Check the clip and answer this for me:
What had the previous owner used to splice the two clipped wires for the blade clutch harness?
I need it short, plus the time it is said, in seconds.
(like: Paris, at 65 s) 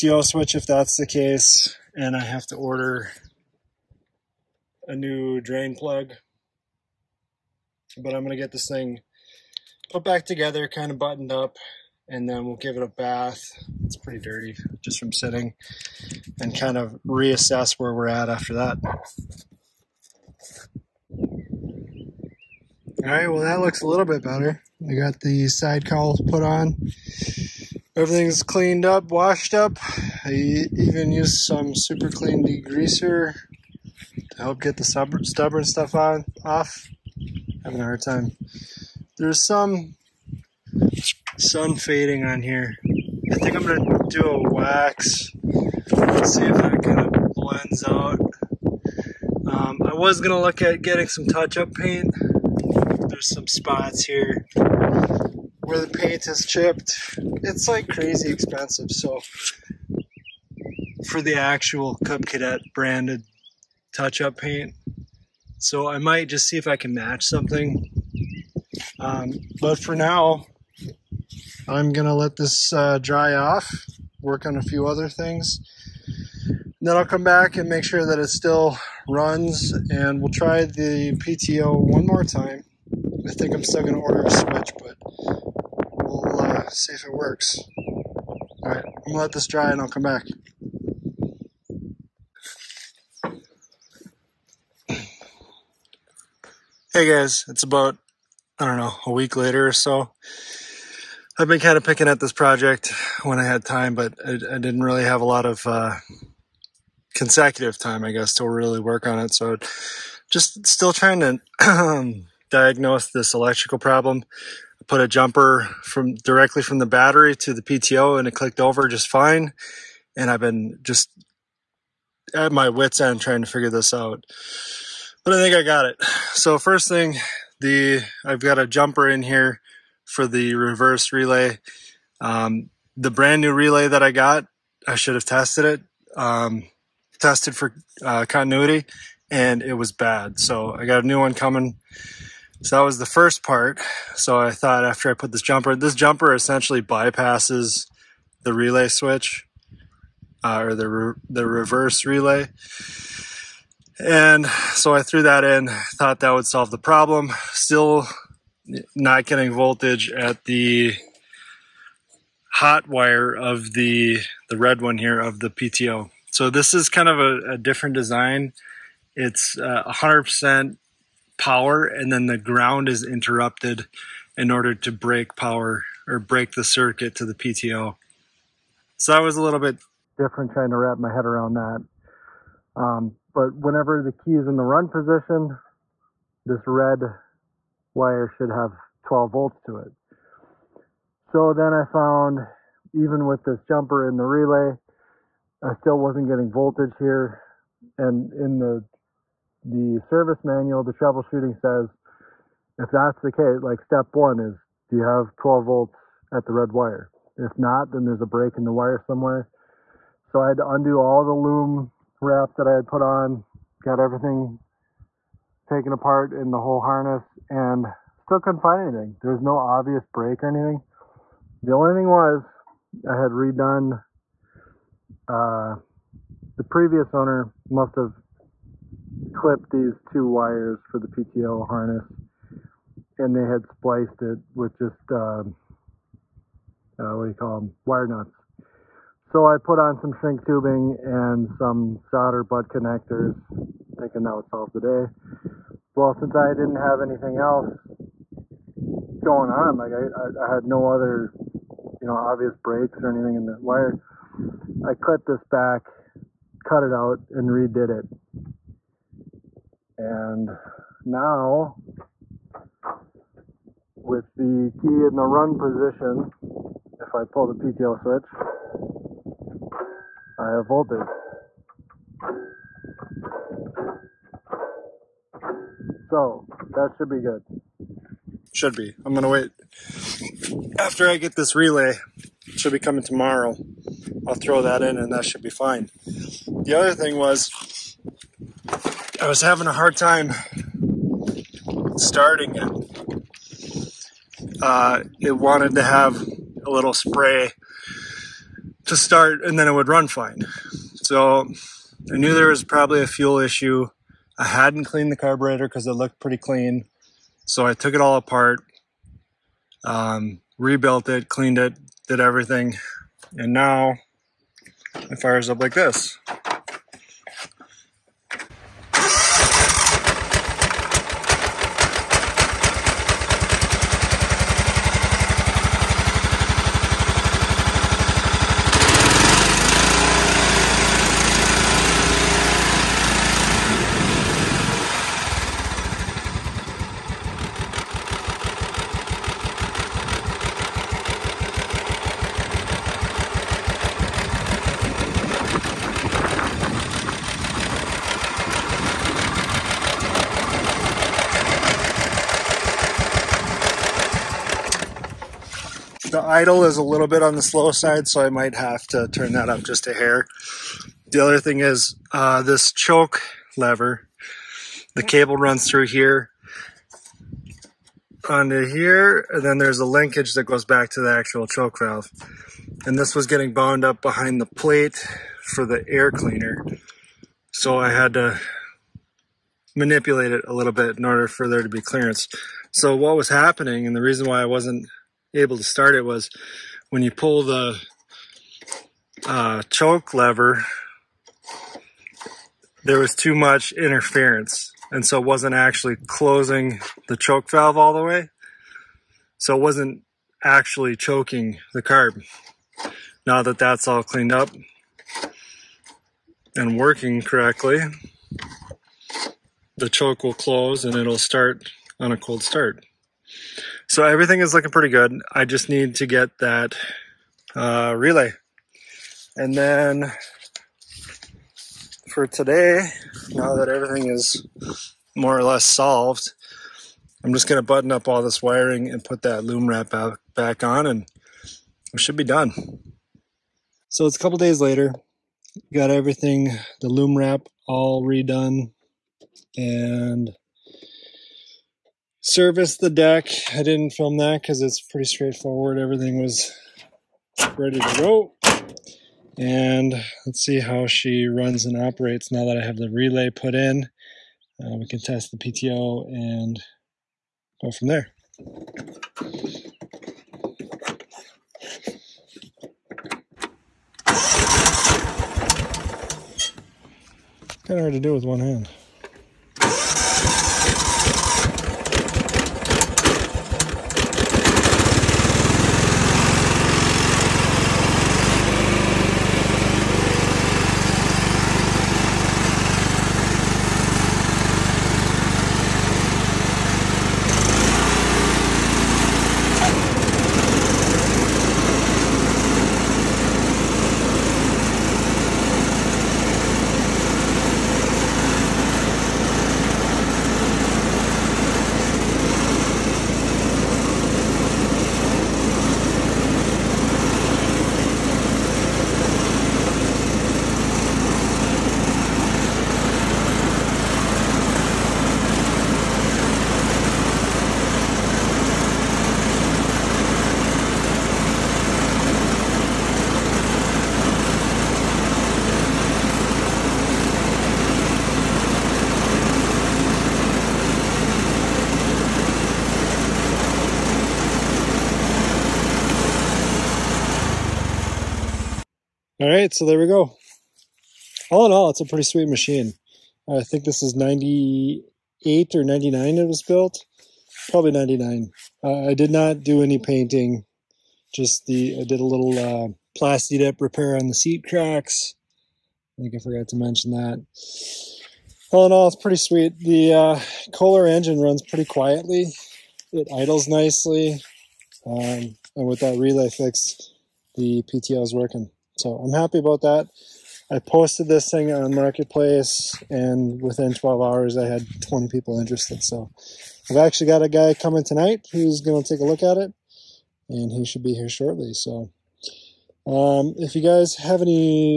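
wire nuts, at 237 s.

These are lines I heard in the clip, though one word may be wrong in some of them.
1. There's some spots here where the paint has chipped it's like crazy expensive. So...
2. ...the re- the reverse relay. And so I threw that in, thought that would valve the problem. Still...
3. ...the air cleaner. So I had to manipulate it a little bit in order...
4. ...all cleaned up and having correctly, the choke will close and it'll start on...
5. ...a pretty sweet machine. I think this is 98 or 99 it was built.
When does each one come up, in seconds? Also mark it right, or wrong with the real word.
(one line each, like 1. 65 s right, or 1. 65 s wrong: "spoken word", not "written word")
1. 53 s right
2. 150 s wrong: "solve", not "valve"
3. 375 s right
4. 403 s wrong: "working", not "having"
5. 541 s right.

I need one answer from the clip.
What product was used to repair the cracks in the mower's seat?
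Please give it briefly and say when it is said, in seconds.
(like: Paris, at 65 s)
Plasti Dip, at 552 s.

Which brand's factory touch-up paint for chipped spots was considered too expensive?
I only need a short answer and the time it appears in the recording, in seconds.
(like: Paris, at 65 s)
Cub Cadet, at 62 s.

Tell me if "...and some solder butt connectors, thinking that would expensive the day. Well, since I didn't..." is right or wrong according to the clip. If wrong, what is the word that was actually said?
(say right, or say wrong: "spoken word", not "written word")
wrong: "solve", not "expensive".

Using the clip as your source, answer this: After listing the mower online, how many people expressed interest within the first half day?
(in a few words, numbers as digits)
20.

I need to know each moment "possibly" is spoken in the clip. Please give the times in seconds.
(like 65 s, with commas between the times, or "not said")
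not said.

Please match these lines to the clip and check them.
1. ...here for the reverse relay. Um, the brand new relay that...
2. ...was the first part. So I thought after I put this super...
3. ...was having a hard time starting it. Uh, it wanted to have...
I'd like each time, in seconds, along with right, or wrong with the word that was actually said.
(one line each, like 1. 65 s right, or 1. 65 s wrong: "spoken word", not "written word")
1. 129 s right
2. 142 s wrong: "jumper", not "super"
3. 289 s right.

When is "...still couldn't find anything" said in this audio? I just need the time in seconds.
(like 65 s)
218 s.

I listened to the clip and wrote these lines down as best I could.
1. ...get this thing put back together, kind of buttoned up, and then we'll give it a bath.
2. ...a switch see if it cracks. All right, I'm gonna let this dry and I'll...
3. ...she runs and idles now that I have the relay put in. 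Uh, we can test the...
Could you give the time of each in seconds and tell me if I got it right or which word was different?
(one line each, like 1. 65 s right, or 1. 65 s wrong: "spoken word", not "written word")
1. 8 s right
2. 84 s wrong: "works", not "cracks"
3. 450 s wrong: "operates", not "idles".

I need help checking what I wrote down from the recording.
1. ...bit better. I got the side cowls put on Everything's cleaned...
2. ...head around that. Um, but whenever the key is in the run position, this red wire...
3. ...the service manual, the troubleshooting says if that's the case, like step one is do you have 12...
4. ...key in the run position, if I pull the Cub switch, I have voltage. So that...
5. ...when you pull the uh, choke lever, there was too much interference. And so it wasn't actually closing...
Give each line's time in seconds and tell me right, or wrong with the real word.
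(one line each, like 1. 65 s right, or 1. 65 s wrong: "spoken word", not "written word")
1. 24 s right
2. 181 s right
3. 199 s right
4. 264 s wrong: "PTO", not "Cub"
5. 386 s right.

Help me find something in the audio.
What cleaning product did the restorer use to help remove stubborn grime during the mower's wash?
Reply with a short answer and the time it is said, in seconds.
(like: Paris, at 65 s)
Super Clean degreaser, at 31 s.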